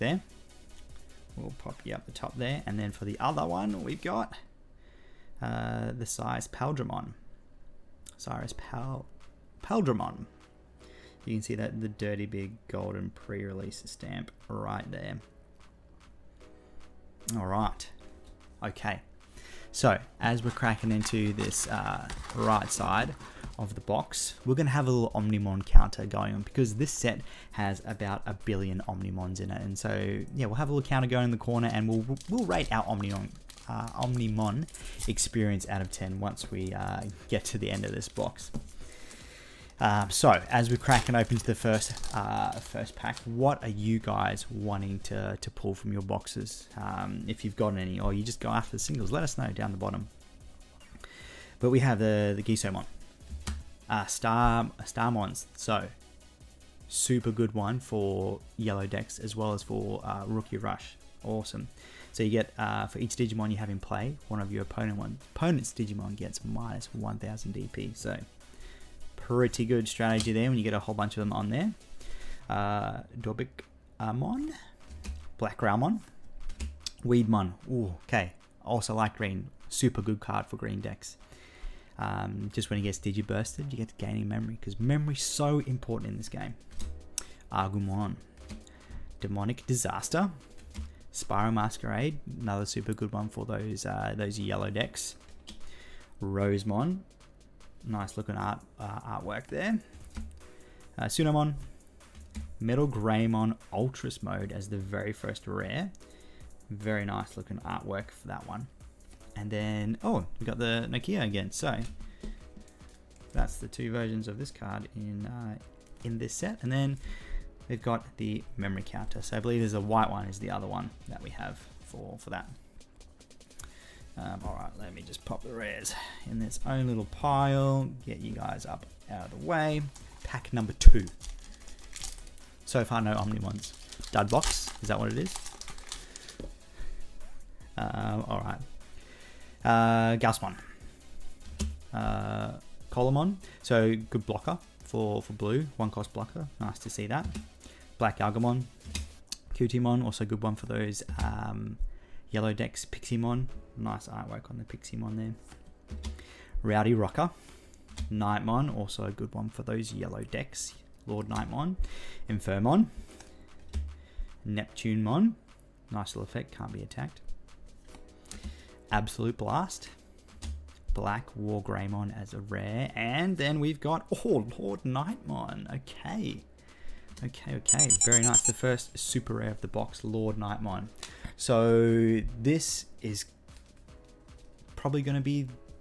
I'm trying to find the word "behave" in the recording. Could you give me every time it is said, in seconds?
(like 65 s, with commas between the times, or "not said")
not said.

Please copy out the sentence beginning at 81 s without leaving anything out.
Um, just when he gets digibursted, you get gaining memory because is so important in this game.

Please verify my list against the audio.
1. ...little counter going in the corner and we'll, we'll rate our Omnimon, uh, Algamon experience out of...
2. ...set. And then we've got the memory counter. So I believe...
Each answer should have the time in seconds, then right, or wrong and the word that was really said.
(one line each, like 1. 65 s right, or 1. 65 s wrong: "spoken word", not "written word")
1. 30 s wrong: "Omnimon", not "Algamon"
2. 116 s right.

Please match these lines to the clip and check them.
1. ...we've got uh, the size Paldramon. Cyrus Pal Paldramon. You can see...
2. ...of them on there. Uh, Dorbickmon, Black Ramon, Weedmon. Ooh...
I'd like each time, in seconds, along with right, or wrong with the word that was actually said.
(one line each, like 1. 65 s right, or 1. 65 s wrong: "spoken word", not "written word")
1. 3 s right
2. 71 s right.